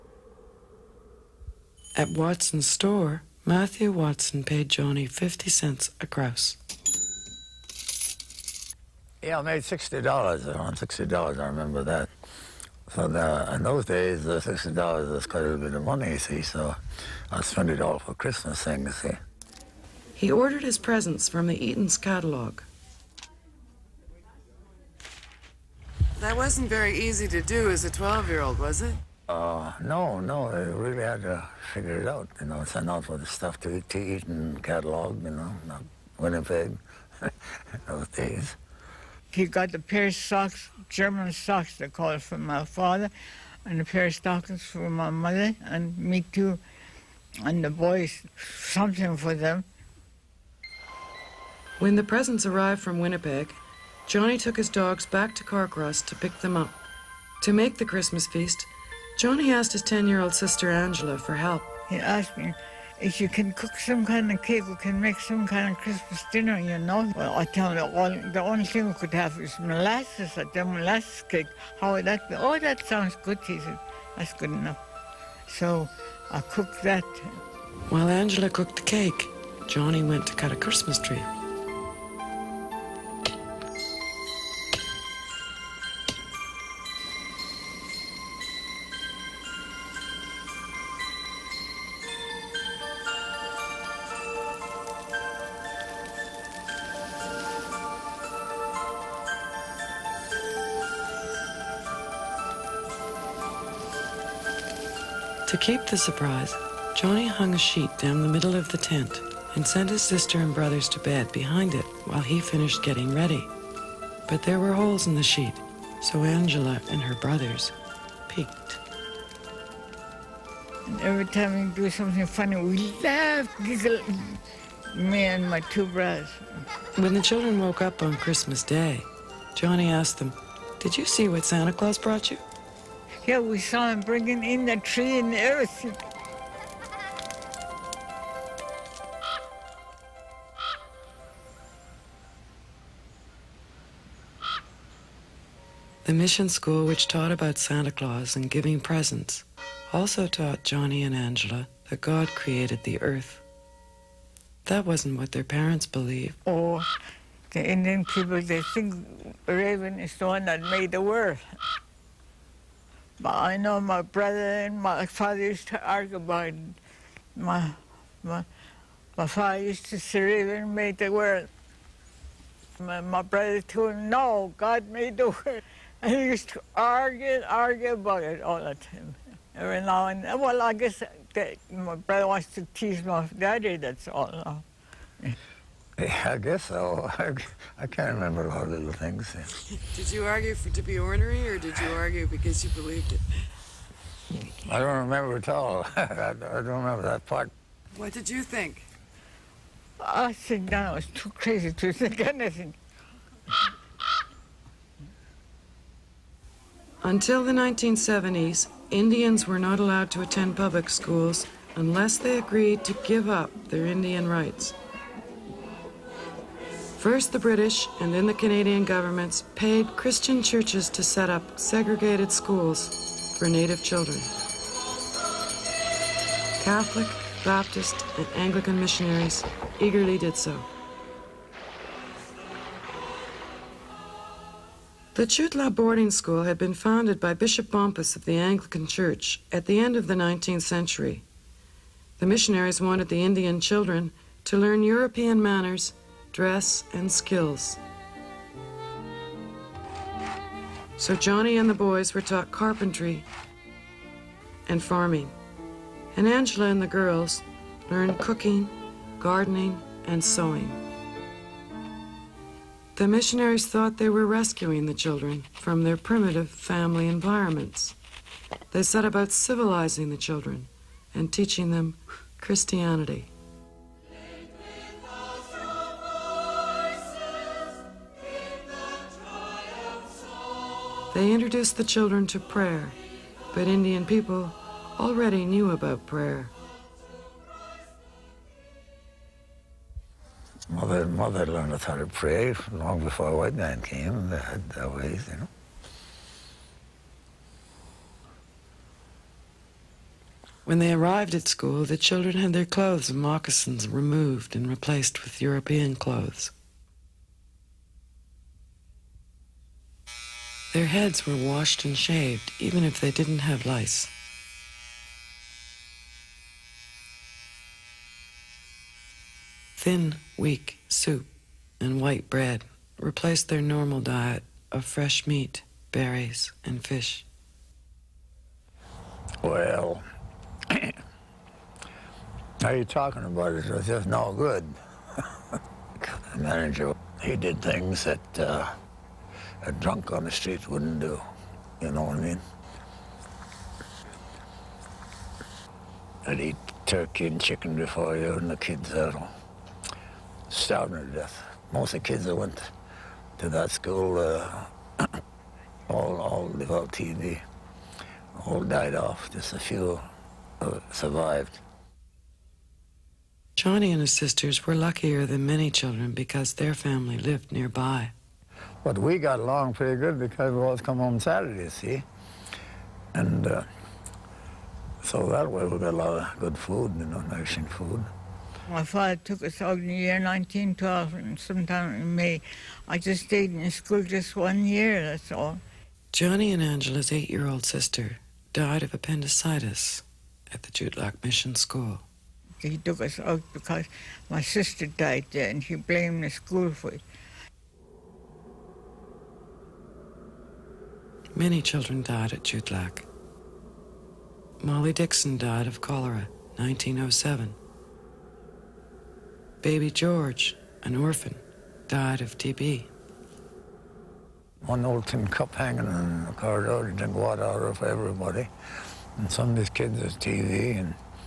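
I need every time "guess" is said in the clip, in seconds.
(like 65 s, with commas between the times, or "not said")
180 s, 186 s.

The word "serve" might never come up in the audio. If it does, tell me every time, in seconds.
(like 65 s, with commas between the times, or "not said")
not said.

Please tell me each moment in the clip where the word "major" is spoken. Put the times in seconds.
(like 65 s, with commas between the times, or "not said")
not said.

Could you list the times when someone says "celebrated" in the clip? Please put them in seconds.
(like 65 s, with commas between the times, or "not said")
not said.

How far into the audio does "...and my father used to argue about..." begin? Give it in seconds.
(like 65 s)
164 s.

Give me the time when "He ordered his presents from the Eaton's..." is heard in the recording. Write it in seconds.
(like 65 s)
20 s.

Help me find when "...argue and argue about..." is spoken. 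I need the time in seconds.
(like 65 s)
176 s.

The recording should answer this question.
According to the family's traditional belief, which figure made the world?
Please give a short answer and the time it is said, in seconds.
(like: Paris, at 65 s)
Raven, at 159 s.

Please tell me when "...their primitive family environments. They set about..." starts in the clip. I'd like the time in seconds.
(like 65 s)
265 s.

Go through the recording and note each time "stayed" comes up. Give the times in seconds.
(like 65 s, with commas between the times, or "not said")
383 s.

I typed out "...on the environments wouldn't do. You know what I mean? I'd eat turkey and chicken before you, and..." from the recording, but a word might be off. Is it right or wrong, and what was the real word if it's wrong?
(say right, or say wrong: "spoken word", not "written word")
wrong: "streets", not "environments".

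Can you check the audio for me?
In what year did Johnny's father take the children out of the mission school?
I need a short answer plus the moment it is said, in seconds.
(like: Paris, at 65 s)
1912, at 380 s.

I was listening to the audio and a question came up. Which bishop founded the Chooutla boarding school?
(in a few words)
Bishop Bompas.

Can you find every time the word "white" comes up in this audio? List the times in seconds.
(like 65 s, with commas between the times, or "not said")
293 s, 321 s.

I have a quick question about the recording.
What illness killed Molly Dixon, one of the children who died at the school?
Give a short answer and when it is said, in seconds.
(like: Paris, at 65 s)
Cholera, at 405 s.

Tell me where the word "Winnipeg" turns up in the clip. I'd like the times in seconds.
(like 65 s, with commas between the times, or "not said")
36 s, 52 s.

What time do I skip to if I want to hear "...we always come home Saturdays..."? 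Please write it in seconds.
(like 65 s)
370 s.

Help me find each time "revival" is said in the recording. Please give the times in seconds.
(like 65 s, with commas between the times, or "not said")
not said.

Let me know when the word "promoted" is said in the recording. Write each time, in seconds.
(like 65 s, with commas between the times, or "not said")
not said.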